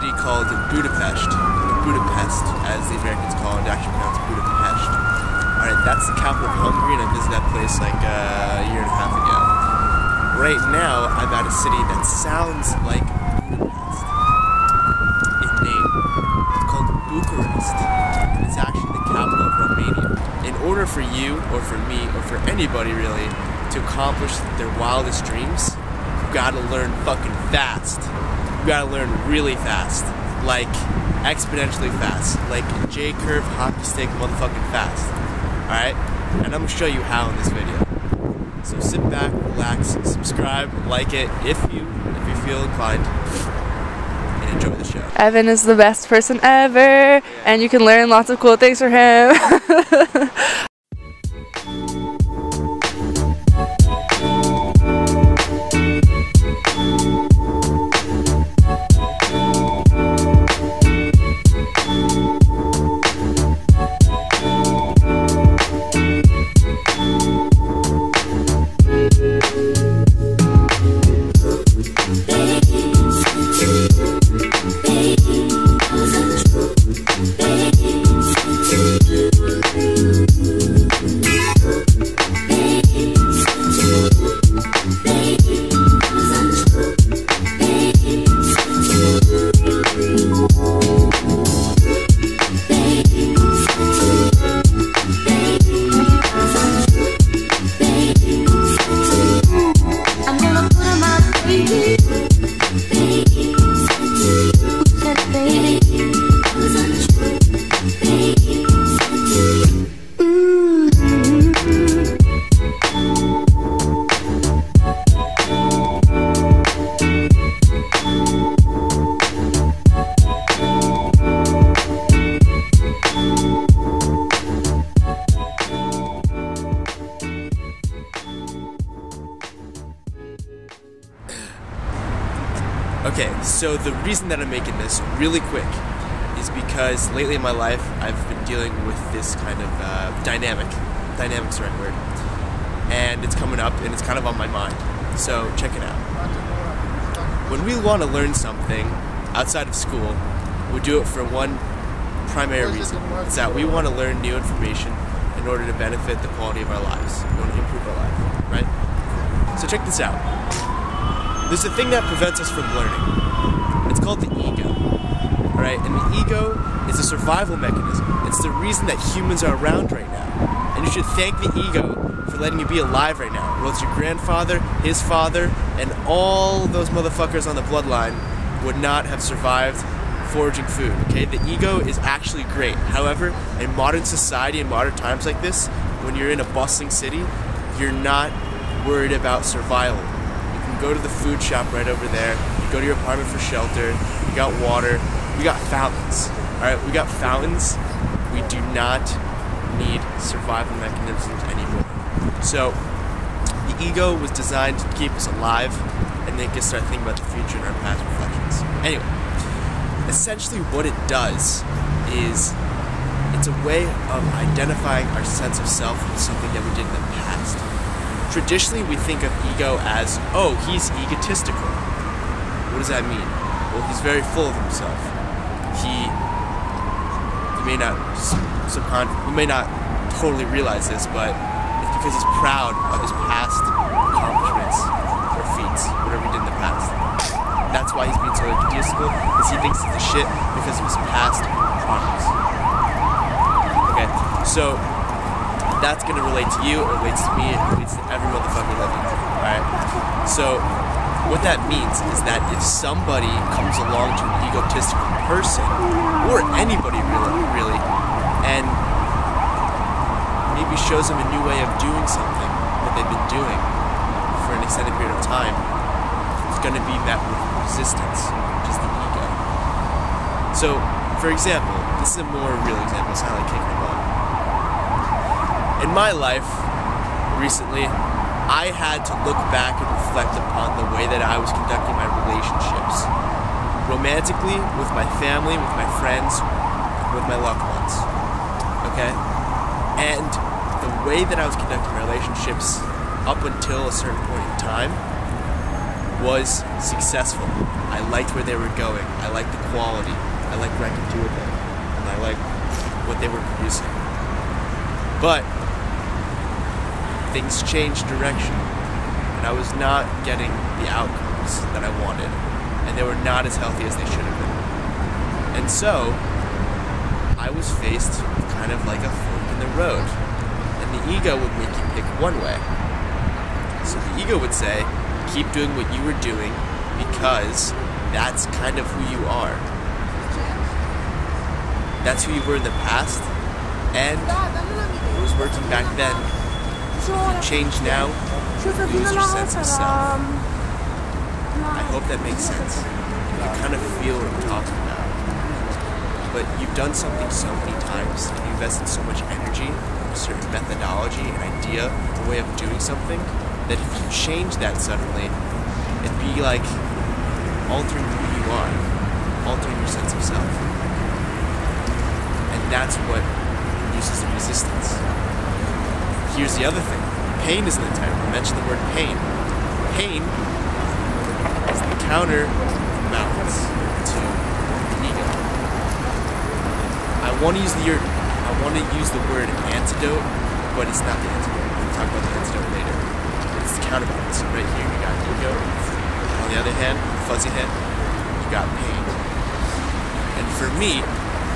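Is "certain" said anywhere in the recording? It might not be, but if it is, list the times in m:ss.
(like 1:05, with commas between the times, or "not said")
4:53, 5:50.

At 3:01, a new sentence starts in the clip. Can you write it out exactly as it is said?
Okay, the ego is actually great.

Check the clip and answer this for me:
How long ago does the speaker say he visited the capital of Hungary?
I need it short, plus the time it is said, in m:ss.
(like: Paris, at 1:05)
A year and a half, at 0:08.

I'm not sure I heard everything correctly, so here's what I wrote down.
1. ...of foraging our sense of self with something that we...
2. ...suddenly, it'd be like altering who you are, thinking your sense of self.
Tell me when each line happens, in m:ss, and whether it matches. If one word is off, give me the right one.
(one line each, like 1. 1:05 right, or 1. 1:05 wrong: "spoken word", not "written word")
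1. 3:34 wrong: "identifying", not "foraging"
2. 5:54 wrong: "altering", not "thinking".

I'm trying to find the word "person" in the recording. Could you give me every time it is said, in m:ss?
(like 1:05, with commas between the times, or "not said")
0:46, 4:15.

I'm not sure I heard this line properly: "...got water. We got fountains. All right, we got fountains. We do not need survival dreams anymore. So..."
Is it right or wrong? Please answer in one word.
wrong.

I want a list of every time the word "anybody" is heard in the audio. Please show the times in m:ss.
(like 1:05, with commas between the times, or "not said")
0:22, 4:16.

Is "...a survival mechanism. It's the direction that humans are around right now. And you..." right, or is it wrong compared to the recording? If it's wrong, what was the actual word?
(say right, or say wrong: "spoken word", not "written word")
wrong: "reason", not "direction".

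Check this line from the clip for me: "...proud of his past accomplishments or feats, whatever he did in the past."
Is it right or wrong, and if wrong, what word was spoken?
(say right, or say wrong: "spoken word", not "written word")
right.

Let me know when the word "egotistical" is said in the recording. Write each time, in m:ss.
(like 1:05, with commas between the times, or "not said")
3:41, 3:58, 4:14.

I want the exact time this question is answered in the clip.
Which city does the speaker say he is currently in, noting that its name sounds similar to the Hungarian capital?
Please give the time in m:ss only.
0:17.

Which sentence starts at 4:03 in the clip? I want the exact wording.
Okay, so that's gonna relate to you, it relates to me, it relates to every motherfucker living.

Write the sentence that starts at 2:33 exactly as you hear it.
It's that we want to learn new information in order to benefit the quality of our lives.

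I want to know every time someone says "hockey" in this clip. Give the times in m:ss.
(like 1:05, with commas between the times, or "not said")
0:33.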